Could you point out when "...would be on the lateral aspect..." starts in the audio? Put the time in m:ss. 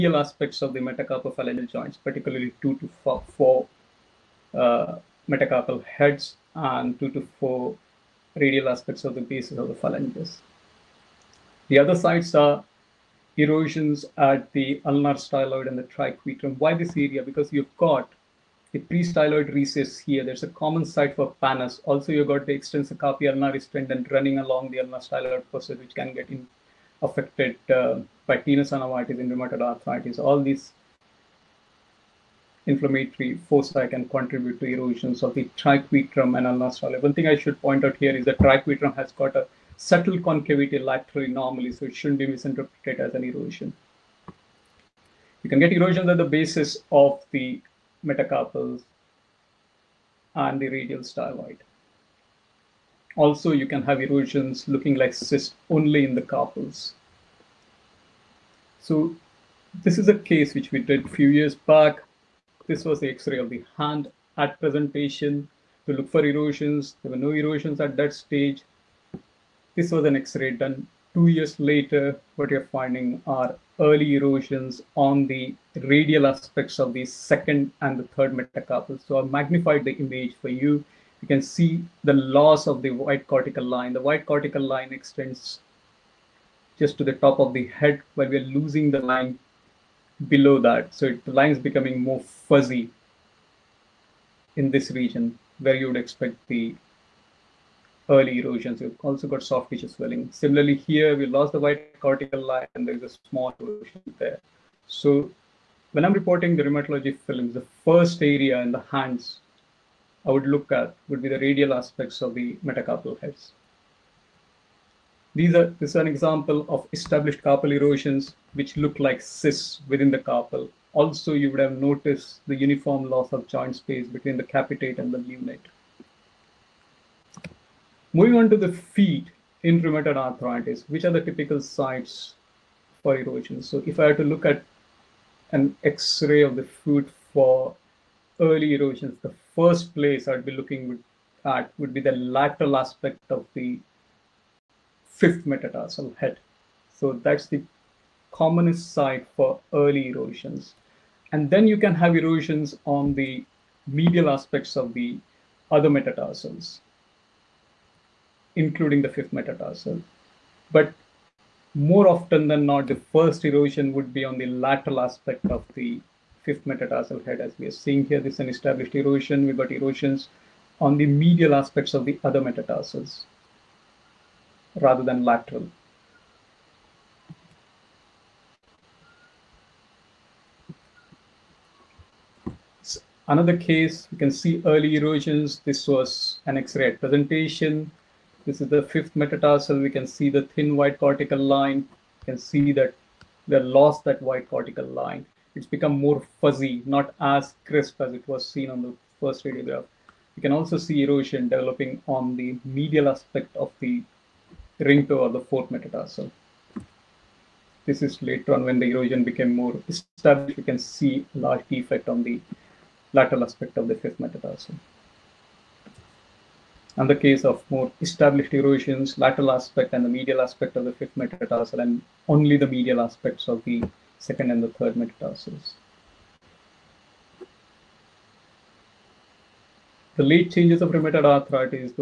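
2:43.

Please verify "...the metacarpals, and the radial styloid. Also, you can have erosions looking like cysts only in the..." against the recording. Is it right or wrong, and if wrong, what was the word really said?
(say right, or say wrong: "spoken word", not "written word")
right.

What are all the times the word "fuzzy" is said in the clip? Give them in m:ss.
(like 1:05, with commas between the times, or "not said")
1:32, 3:16.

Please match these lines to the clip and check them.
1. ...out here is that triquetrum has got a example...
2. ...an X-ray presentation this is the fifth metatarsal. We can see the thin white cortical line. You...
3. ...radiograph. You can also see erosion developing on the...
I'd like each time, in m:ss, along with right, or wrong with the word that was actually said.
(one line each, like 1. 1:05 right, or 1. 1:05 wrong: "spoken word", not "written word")
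1. 0:37 wrong: "subtle", not "example"
2. 3:06 right
3. 3:19 right.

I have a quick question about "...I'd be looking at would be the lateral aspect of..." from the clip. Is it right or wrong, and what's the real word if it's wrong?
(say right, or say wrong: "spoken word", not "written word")
right.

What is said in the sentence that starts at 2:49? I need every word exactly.
We've got erosions on the medial aspects of the other metatarsals rather than lateral.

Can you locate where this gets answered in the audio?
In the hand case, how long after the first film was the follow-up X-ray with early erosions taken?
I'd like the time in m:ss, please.
1:11.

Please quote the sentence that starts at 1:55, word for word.
These are, this is an example of established carpal erosions, which look like cysts within the carpal.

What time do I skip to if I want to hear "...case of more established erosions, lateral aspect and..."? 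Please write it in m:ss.
3:37.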